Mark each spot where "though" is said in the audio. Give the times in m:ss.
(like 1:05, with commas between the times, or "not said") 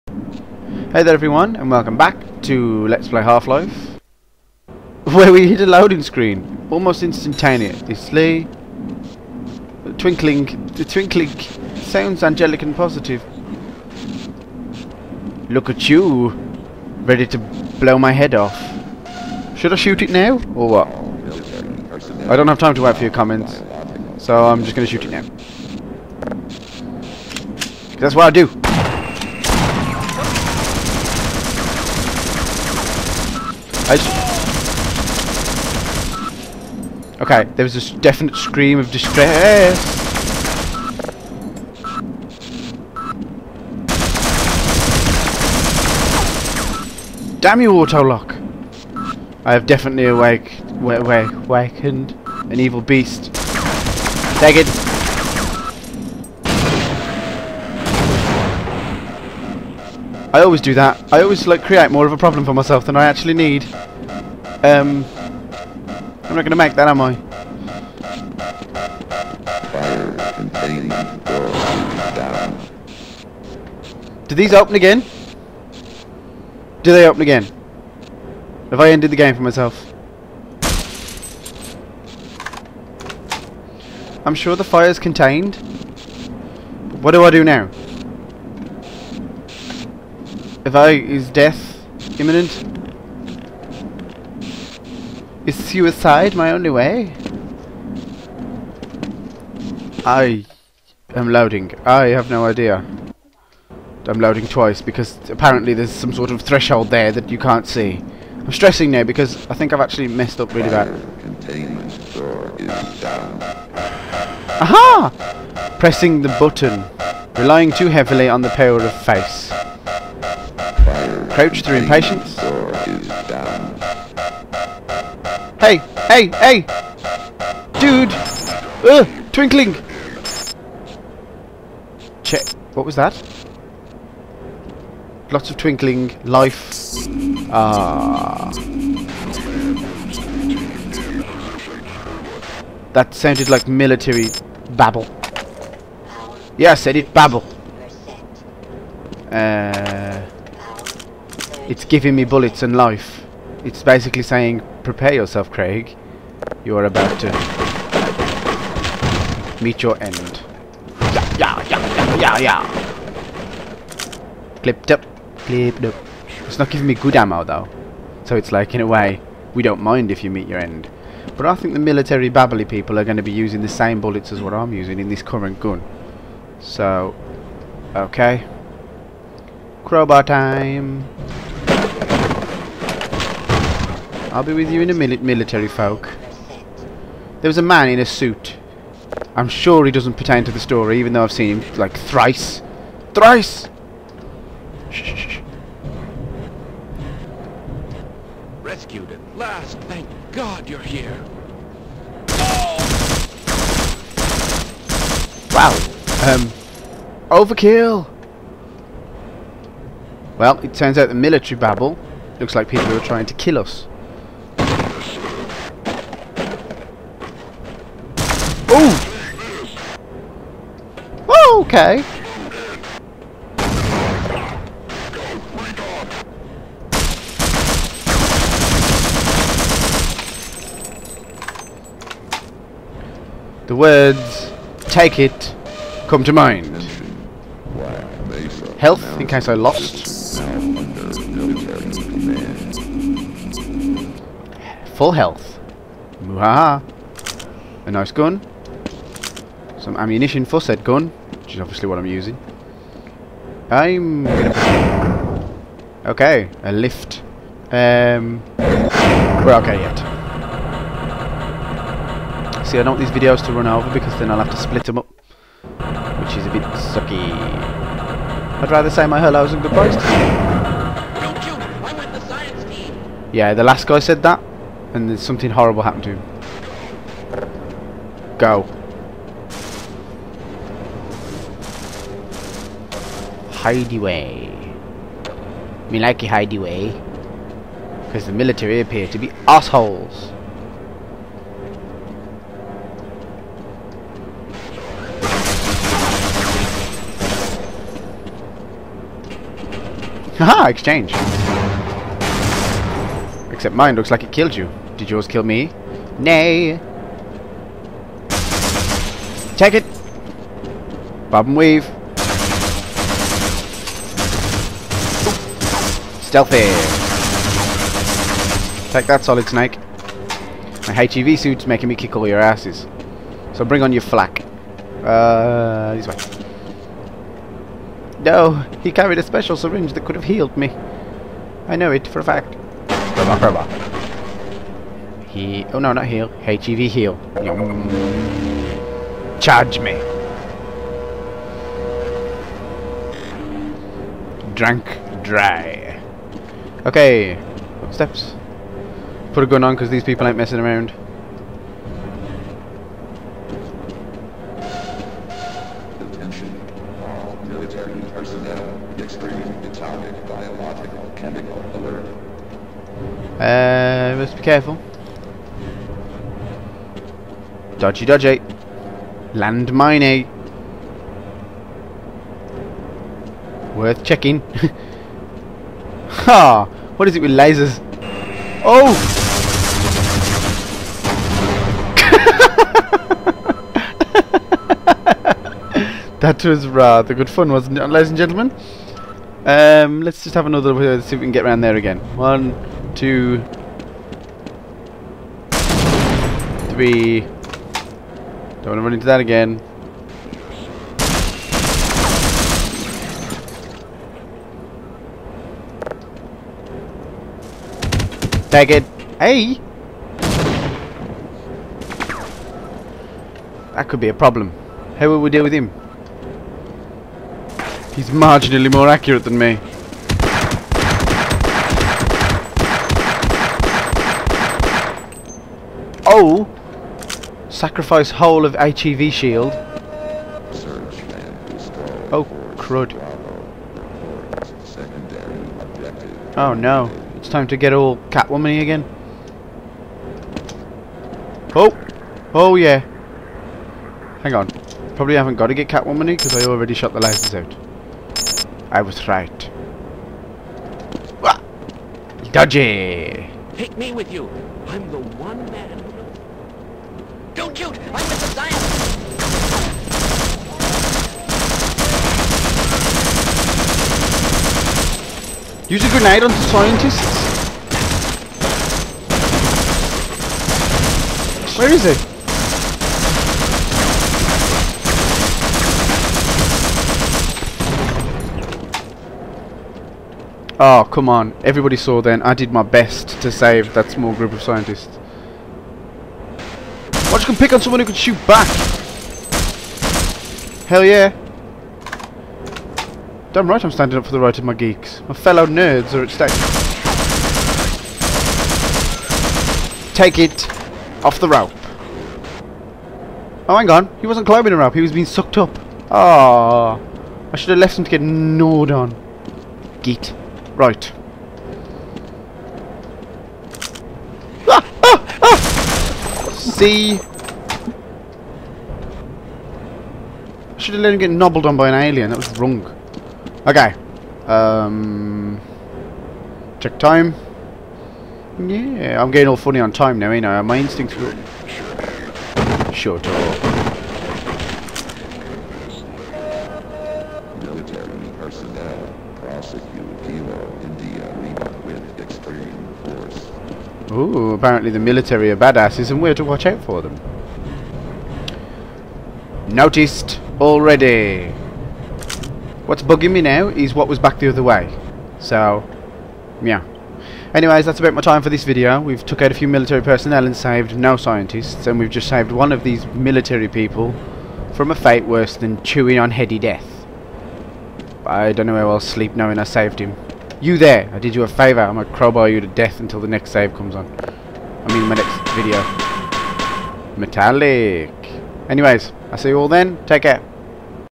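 2:47, 3:11.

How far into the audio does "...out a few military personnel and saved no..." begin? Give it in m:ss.
9:19.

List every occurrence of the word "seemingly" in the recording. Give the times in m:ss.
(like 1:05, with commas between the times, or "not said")
not said.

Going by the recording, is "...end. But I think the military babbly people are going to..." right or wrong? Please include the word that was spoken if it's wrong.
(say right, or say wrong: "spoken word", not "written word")
right.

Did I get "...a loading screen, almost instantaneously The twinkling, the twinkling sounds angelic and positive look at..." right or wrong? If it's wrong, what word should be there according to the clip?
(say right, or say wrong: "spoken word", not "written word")
right.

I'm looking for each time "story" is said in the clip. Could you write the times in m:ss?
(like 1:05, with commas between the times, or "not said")
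3:10.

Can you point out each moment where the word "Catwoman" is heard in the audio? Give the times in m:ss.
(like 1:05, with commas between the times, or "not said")
7:18, 7:25.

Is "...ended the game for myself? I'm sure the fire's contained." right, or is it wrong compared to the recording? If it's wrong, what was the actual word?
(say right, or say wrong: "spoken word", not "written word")
right.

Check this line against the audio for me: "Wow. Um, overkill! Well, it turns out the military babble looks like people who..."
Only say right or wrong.
right.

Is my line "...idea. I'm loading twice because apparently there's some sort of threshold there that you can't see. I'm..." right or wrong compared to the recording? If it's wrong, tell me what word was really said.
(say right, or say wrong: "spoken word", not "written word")
right.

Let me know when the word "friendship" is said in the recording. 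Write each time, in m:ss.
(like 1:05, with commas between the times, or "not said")
not said.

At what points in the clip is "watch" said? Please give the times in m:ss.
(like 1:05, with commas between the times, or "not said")
8:07, 9:06.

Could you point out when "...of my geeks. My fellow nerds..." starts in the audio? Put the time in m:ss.
8:14.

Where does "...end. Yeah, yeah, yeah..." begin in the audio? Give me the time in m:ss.
2:40.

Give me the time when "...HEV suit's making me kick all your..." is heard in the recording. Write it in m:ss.
5:20.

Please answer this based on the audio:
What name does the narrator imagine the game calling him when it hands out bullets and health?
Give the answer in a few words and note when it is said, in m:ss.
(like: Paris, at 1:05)
Craig, at 2:35.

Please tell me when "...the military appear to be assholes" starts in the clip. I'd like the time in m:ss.
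4:48.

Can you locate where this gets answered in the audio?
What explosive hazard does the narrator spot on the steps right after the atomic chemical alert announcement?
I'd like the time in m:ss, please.
6:09.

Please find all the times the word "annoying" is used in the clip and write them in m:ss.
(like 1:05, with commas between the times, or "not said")
not said.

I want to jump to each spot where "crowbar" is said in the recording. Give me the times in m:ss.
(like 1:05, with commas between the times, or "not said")
2:59, 5:32, 9:31.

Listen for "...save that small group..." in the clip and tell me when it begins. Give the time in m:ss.
8:03.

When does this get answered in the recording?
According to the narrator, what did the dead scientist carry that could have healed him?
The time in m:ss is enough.
5:29.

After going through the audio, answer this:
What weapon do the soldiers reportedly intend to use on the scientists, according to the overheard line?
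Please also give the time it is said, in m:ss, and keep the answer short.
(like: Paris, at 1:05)
a grenade, at 7:45.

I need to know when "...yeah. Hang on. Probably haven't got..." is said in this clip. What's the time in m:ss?
7:22.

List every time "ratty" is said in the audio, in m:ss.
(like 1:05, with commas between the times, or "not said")
not said.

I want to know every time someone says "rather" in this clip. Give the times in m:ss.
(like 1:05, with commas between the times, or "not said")
4:28, 6:26.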